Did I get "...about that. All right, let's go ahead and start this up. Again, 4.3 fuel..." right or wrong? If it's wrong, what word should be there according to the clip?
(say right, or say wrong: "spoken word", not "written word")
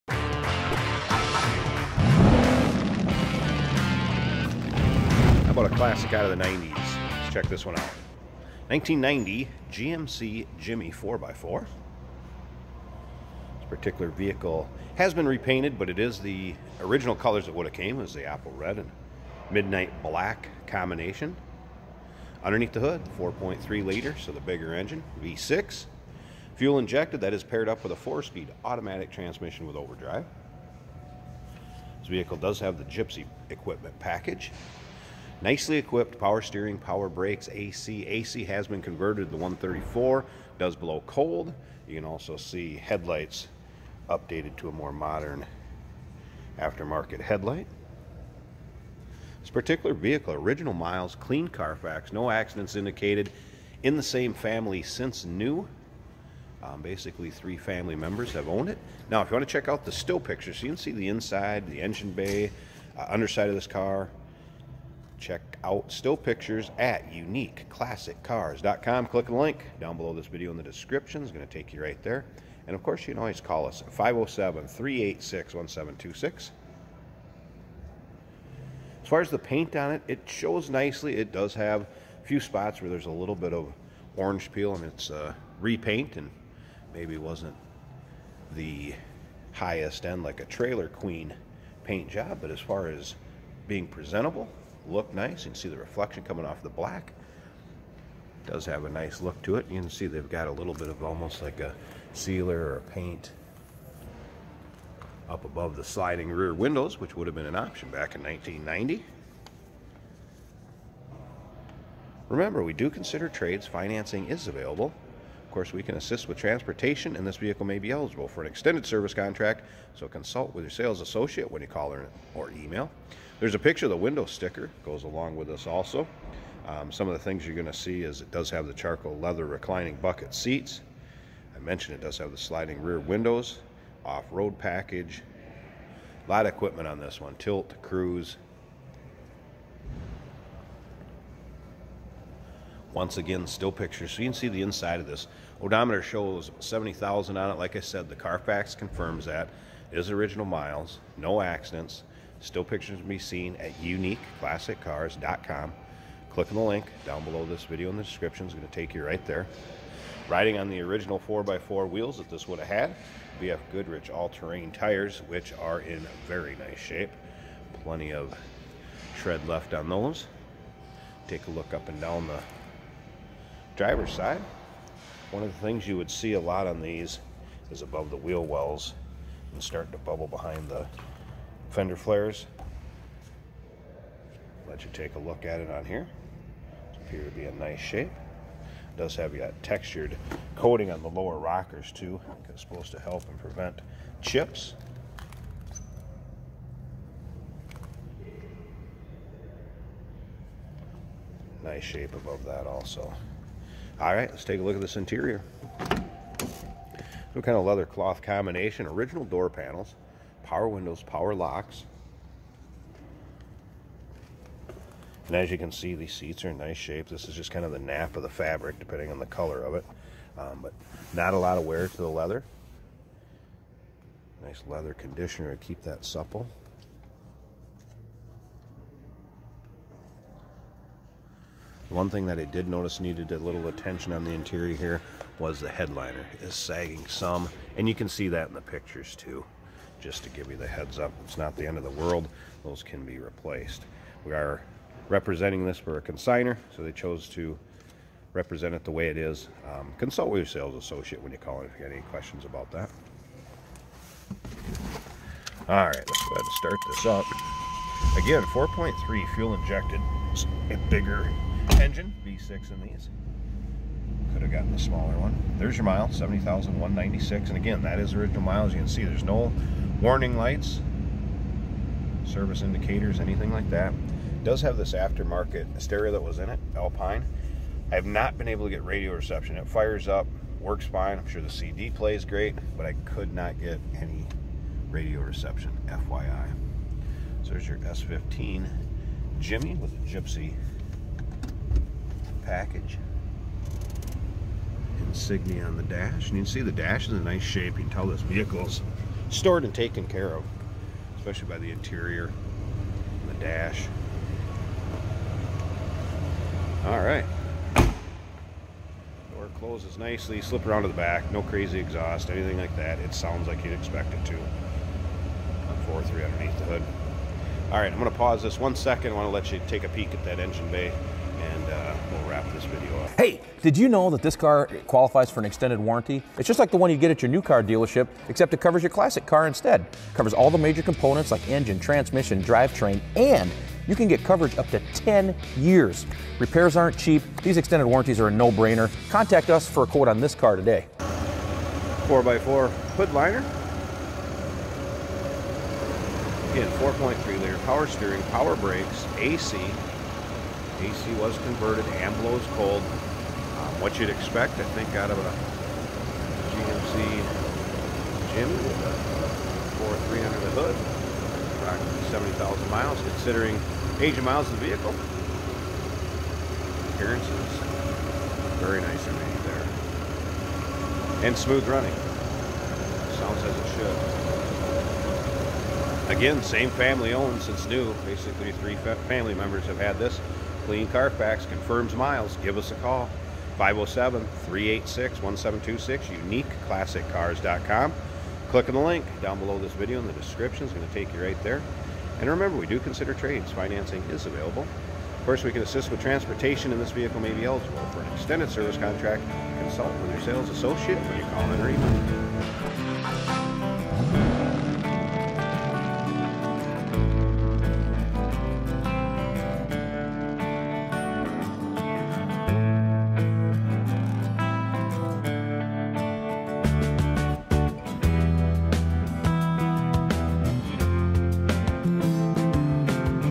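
right.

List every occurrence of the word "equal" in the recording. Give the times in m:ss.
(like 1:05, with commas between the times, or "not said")
not said.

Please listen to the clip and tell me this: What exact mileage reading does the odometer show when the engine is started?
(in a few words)
70,196.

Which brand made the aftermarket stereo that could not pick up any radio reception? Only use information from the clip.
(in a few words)
Alpine.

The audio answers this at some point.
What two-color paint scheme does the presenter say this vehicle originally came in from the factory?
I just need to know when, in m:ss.
0:18.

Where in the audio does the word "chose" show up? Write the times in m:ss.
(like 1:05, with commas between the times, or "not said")
4:06.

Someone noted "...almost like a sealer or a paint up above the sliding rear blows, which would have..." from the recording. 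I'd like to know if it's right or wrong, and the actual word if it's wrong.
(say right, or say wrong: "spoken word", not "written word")
wrong: "windows", not "blows".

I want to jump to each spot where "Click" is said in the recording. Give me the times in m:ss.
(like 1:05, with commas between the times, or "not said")
1:09, 2:36, 6:28.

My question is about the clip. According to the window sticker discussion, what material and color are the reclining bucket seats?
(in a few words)
charcoal leather.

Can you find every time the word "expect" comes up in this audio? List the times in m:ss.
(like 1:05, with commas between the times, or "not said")
5:13, 5:54.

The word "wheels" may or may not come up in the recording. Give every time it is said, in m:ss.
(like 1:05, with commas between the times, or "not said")
2:41, 2:58.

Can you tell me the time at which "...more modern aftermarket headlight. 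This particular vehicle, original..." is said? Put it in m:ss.
0:44.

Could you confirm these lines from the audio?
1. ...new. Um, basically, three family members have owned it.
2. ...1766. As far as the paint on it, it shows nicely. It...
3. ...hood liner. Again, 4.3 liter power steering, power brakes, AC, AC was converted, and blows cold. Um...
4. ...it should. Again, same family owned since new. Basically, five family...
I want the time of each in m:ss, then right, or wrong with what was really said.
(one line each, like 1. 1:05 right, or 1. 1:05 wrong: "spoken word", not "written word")
1. 0:55 right
2. 1:15 wrong: "1726", not "1766"
3. 5:42 right
4. 6:13 wrong: "three", not "five".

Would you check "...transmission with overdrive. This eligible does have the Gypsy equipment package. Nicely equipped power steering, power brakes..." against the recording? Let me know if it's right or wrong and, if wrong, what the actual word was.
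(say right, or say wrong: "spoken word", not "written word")
wrong: "vehicle", not "eligible".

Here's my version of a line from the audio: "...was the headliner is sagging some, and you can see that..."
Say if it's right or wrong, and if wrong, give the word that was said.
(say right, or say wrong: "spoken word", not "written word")
right.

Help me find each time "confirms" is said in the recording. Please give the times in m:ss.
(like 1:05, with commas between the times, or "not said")
2:28, 6:21.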